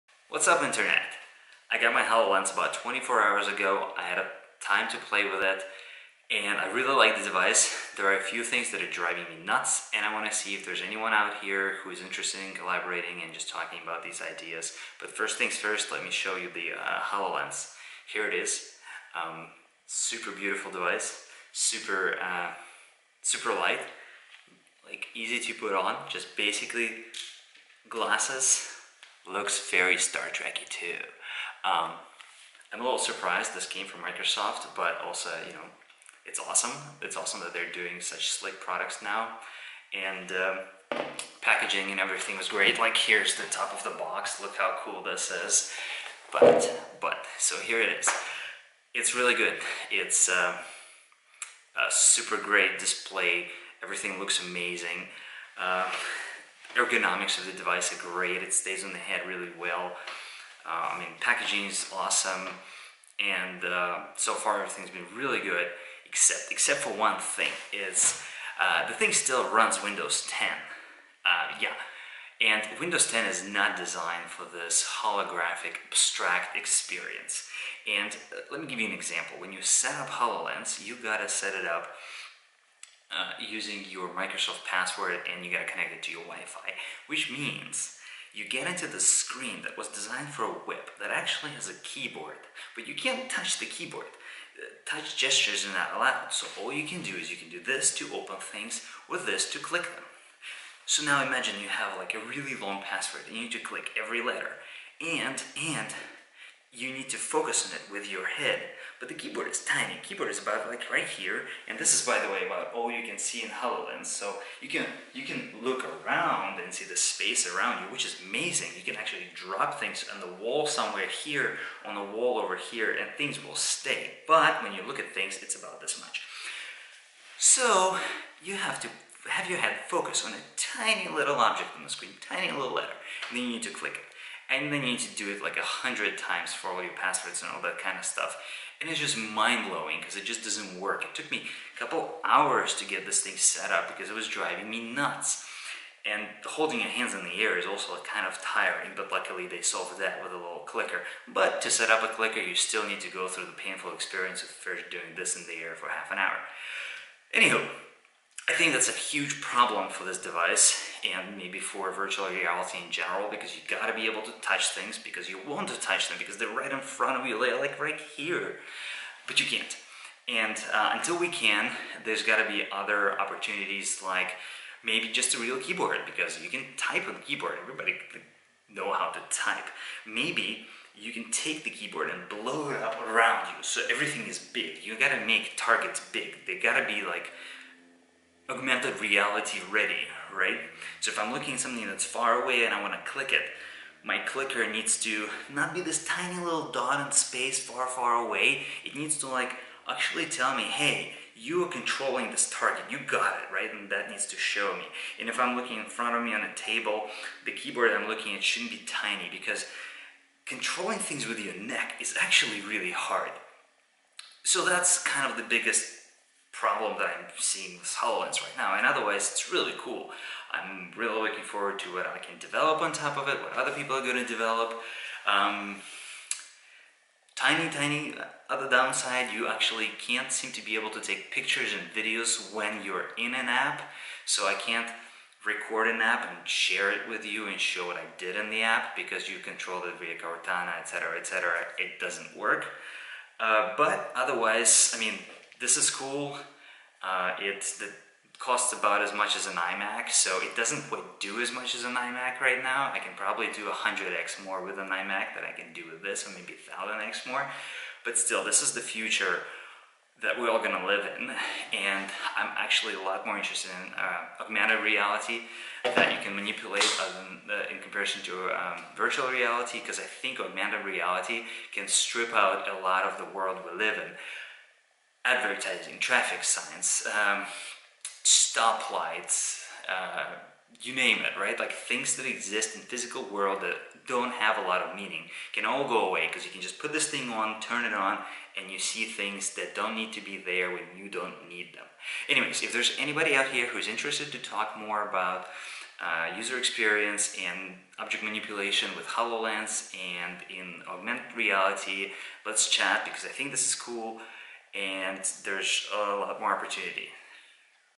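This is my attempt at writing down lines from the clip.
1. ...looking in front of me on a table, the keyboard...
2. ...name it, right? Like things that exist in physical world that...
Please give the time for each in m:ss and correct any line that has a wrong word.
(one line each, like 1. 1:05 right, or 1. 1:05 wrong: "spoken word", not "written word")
1. 3:25 right
2. 4:40 right.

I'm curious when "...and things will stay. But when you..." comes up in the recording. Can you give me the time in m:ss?
2:02.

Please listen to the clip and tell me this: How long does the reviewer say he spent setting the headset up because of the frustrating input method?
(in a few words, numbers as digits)
A couple hours.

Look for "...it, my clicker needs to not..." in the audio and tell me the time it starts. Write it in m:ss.
3:13.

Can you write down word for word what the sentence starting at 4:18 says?
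But still, this is the future that we're all gonna live in.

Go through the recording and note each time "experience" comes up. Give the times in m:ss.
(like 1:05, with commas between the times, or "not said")
1:16, 2:33, 4:56.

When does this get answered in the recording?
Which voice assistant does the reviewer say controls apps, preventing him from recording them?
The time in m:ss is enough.
4:00.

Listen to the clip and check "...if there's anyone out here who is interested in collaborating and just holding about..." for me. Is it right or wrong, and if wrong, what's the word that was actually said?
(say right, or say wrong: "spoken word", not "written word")
wrong: "talking", not "holding".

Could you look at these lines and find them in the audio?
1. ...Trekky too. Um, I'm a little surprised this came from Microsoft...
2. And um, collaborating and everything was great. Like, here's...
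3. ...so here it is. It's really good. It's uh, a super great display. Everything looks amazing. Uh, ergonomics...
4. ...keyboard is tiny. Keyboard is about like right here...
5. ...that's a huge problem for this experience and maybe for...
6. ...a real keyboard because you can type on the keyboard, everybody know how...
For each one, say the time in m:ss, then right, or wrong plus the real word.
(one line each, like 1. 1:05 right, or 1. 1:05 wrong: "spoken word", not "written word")
1. 0:30 right
2. 0:39 wrong: "packaging", not "collaborating"
3. 0:47 right
4. 1:49 right
5. 2:38 wrong: "device", not "experience"
6. 2:55 right.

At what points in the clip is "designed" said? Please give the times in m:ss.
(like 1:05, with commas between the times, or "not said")
1:13, 1:29.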